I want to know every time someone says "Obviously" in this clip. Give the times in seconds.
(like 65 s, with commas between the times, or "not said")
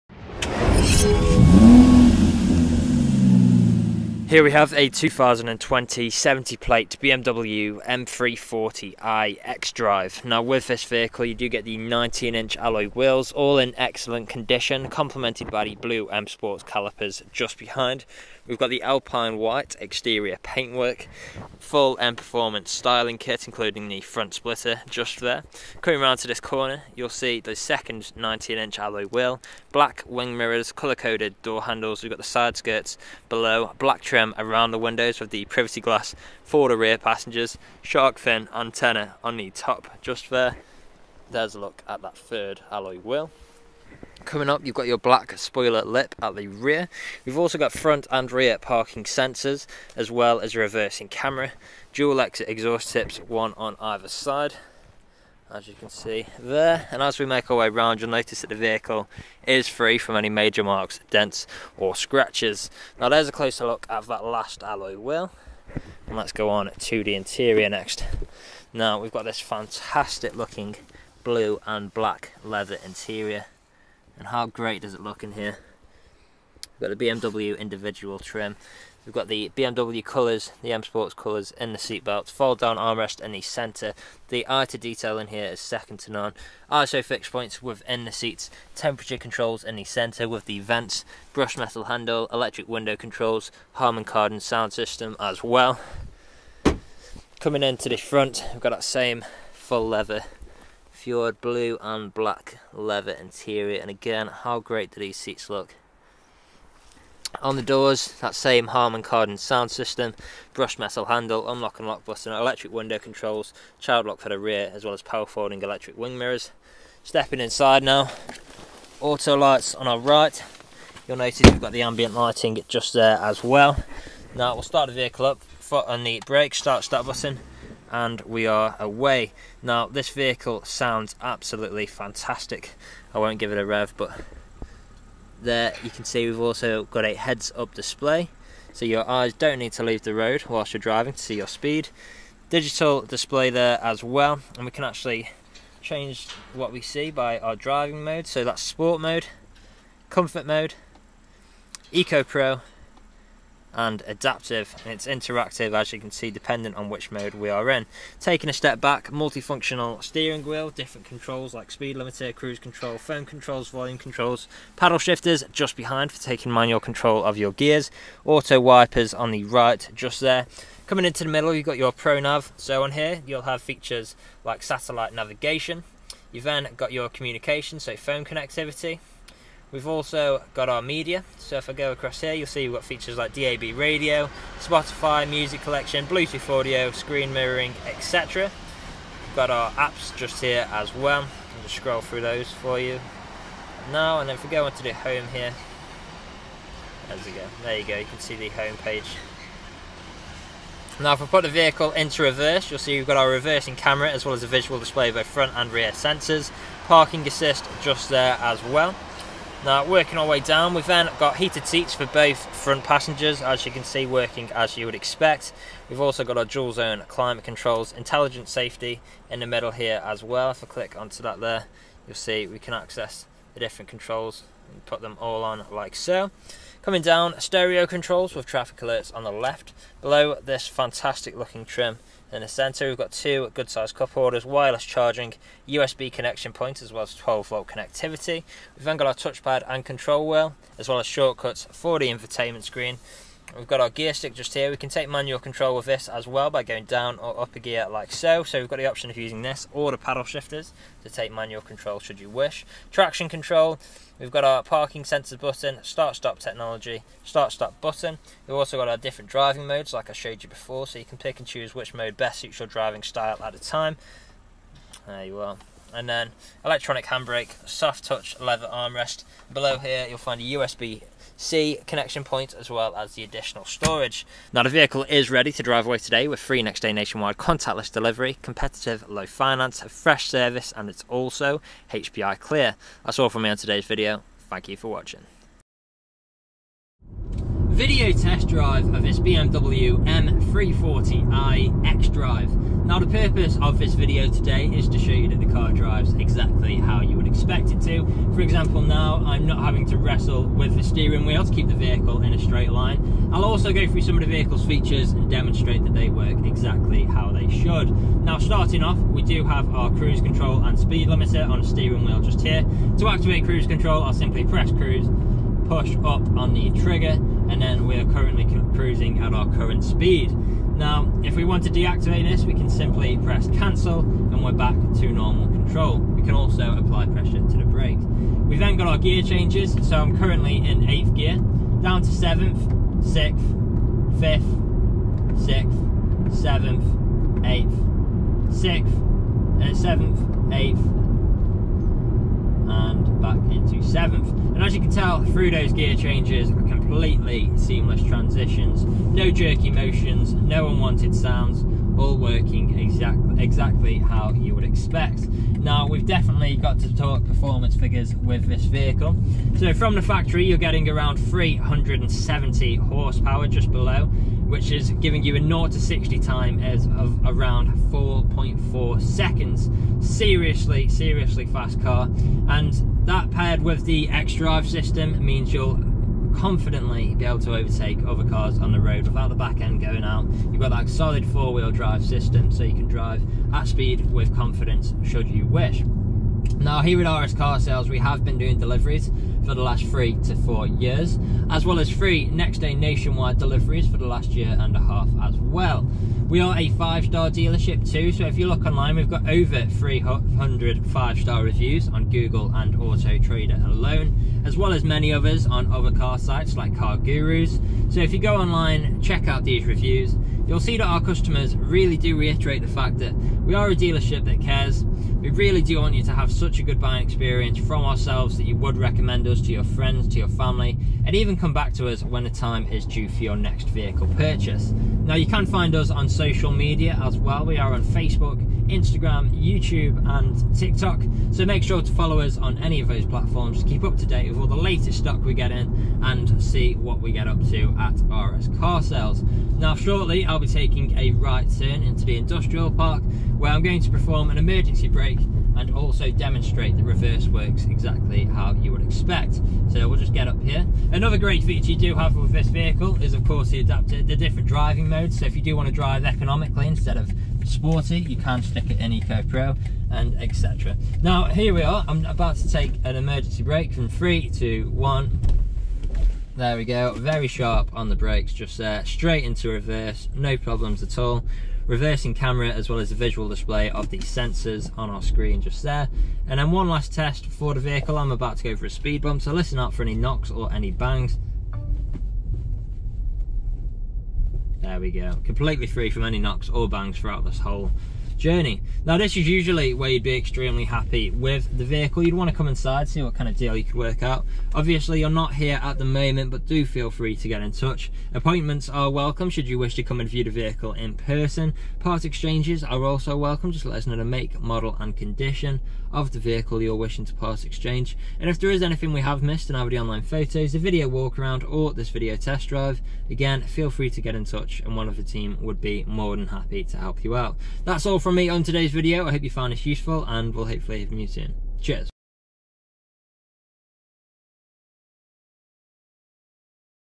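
494 s.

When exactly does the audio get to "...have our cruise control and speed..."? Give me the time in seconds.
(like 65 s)
309 s.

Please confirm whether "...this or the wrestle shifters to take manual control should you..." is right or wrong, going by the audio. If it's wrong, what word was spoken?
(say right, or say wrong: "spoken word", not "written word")
wrong: "paddle", not "wrestle".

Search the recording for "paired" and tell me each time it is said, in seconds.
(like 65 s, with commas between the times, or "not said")
373 s.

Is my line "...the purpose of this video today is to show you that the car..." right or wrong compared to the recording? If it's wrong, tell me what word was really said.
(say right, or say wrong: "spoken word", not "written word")
right.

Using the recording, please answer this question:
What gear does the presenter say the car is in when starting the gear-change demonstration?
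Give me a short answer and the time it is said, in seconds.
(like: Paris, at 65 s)
8th, at 330 s.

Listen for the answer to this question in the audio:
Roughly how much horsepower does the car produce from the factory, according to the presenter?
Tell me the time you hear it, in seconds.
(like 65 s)
361 s.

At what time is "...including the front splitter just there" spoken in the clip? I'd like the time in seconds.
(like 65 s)
23 s.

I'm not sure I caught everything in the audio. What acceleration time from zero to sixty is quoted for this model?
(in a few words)
4.4 seconds.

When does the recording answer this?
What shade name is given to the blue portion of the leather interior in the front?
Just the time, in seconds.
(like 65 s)
100 s.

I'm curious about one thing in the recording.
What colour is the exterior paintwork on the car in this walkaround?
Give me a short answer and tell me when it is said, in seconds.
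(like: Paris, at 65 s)
Alpine white, at 18 s.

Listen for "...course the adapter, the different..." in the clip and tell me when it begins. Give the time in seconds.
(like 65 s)
453 s.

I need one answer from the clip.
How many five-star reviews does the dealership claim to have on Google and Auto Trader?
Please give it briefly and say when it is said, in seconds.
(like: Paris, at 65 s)
over 300, at 399 s.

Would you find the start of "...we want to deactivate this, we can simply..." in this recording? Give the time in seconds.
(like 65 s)
321 s.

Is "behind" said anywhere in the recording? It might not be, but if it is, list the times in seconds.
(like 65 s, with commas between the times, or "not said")
17 s, 165 s.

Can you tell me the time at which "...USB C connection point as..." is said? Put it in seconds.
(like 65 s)
270 s.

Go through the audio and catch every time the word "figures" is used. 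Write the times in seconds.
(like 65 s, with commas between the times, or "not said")
357 s.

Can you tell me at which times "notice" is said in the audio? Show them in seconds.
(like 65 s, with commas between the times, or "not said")
58 s, 121 s.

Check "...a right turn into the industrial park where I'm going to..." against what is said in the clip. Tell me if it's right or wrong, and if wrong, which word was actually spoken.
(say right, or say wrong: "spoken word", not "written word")
right.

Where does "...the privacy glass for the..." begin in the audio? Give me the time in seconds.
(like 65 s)
35 s.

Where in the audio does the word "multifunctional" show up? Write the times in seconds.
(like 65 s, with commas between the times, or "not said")
159 s.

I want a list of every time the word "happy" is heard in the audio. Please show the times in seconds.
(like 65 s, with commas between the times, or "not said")
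490 s, 516 s.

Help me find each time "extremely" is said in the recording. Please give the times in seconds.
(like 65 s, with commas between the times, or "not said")
490 s.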